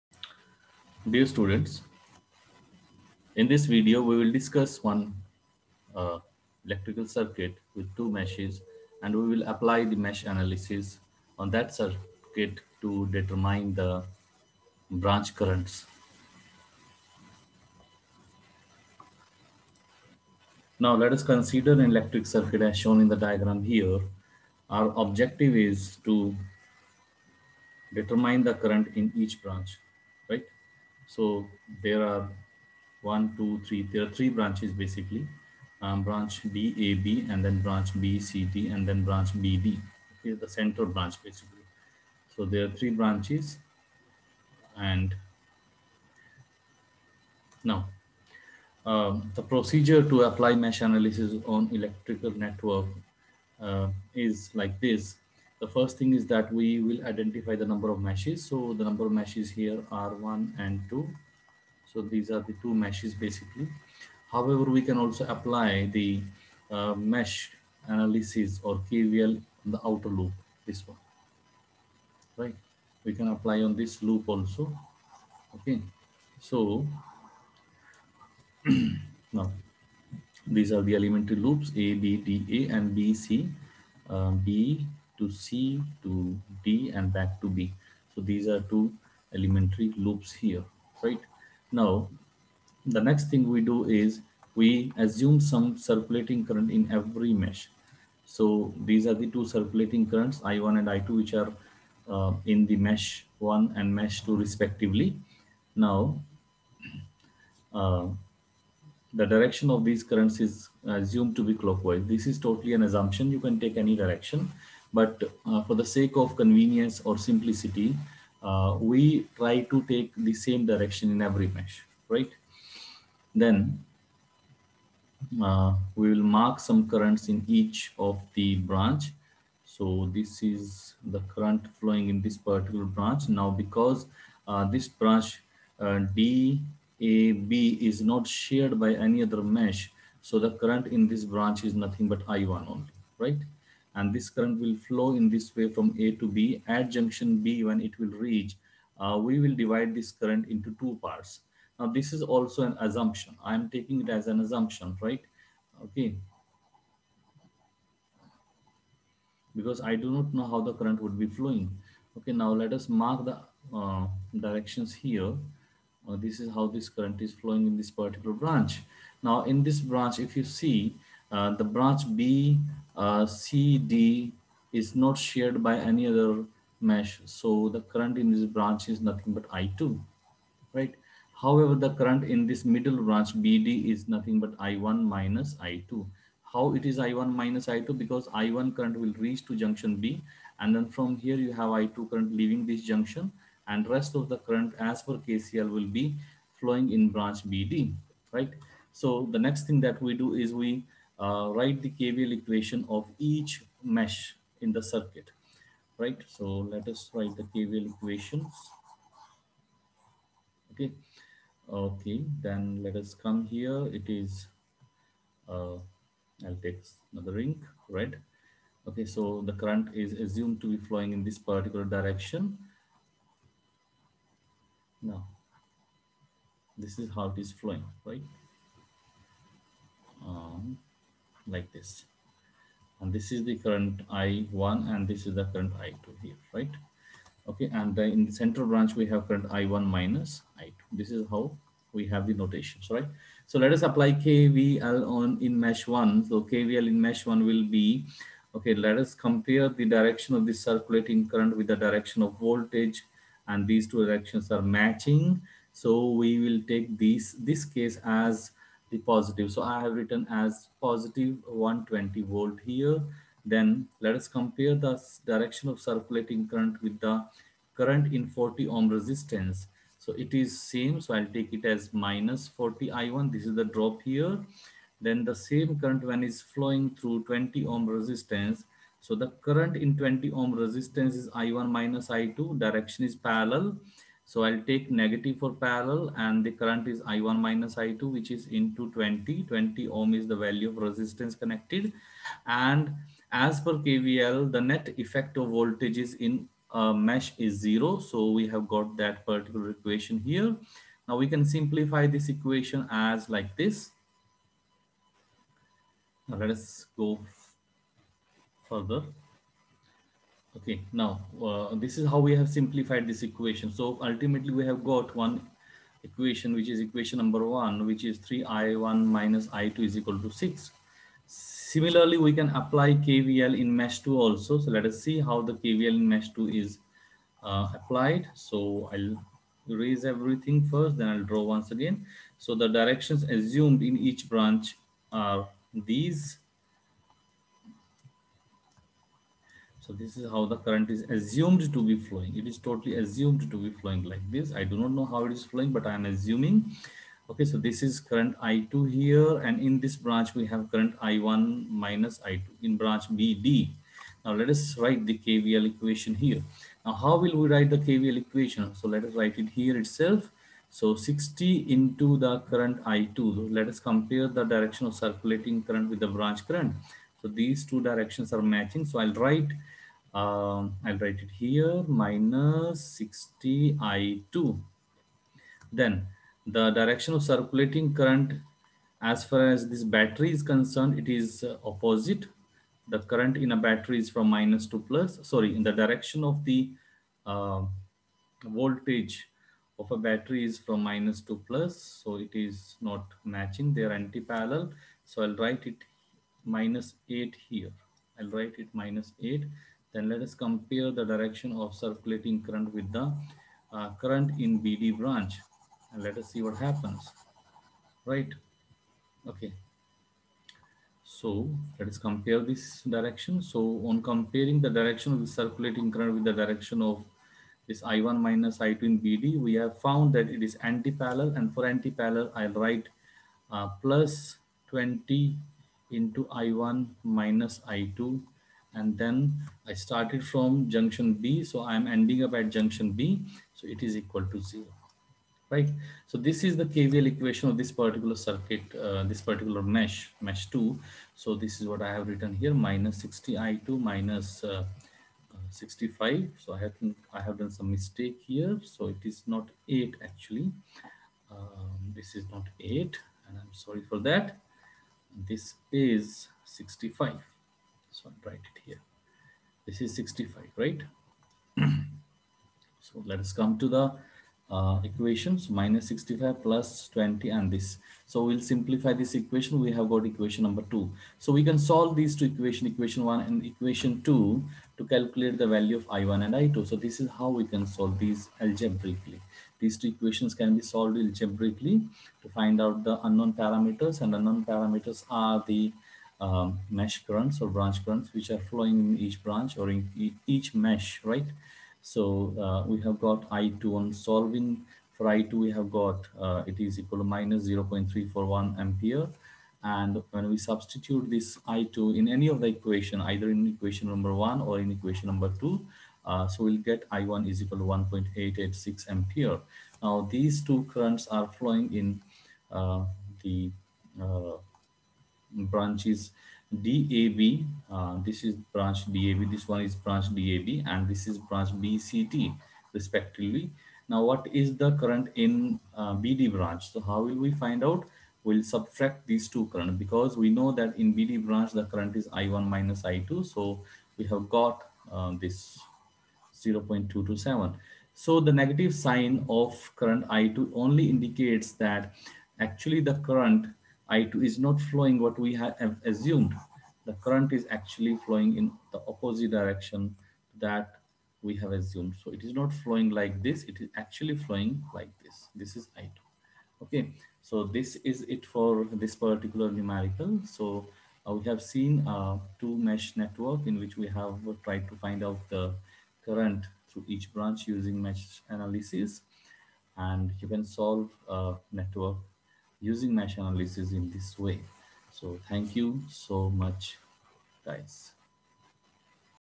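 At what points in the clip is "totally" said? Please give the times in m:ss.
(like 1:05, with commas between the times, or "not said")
1:52, 5:42.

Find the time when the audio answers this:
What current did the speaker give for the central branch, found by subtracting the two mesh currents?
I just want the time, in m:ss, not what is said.
8:56.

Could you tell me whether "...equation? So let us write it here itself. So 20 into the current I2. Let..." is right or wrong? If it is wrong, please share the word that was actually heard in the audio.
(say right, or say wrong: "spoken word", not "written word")
wrong: "60", not "20".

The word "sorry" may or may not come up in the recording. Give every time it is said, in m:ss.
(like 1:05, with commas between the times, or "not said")
6:25, 7:33.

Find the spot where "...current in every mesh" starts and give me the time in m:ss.
1:36.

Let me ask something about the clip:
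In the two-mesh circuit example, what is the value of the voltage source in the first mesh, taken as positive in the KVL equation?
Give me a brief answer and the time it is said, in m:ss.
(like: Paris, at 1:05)
120 volts, at 4:21.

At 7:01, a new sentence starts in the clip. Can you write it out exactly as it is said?
And for antiparallel, I'll write uh, plus 20 into I1 minus I2.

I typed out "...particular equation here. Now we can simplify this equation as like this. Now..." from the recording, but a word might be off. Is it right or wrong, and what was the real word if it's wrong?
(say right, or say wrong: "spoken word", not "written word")
right.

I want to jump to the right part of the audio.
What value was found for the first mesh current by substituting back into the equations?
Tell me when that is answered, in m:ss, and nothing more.
8:27.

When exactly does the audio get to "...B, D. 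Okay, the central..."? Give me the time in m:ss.
0:39.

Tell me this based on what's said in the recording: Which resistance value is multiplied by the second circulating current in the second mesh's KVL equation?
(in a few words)
60 ohm.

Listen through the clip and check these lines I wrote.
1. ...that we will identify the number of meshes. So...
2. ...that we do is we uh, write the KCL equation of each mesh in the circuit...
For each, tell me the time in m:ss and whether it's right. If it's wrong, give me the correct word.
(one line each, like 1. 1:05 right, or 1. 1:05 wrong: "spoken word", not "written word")
1. 0:56 right
2. 3:19 wrong: "KVL", not "KCL".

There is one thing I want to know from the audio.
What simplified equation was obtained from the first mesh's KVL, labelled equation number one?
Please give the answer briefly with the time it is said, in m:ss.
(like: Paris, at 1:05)
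3I1 - I2 = 6, at 5:18.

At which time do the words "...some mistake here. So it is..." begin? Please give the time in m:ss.
7:27.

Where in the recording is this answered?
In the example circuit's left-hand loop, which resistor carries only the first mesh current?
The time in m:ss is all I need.
4:28.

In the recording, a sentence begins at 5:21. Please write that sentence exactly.
Similarly, we can apply KVL in mesh 2 also.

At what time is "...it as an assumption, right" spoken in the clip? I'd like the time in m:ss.
2:34.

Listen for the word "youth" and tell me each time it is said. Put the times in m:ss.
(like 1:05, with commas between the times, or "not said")
not said.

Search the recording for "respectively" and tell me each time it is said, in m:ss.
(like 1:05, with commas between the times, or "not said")
1:44, 8:42.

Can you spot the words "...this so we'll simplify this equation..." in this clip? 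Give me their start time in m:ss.
7:47.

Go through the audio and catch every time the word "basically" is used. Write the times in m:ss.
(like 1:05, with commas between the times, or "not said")
0:34, 0:41, 1:03.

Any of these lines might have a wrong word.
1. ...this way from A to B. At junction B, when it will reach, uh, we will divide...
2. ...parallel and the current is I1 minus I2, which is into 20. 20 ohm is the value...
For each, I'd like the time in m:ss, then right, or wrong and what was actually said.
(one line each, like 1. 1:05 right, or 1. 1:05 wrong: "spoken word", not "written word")
1. 2:25 right
2. 4:45 right.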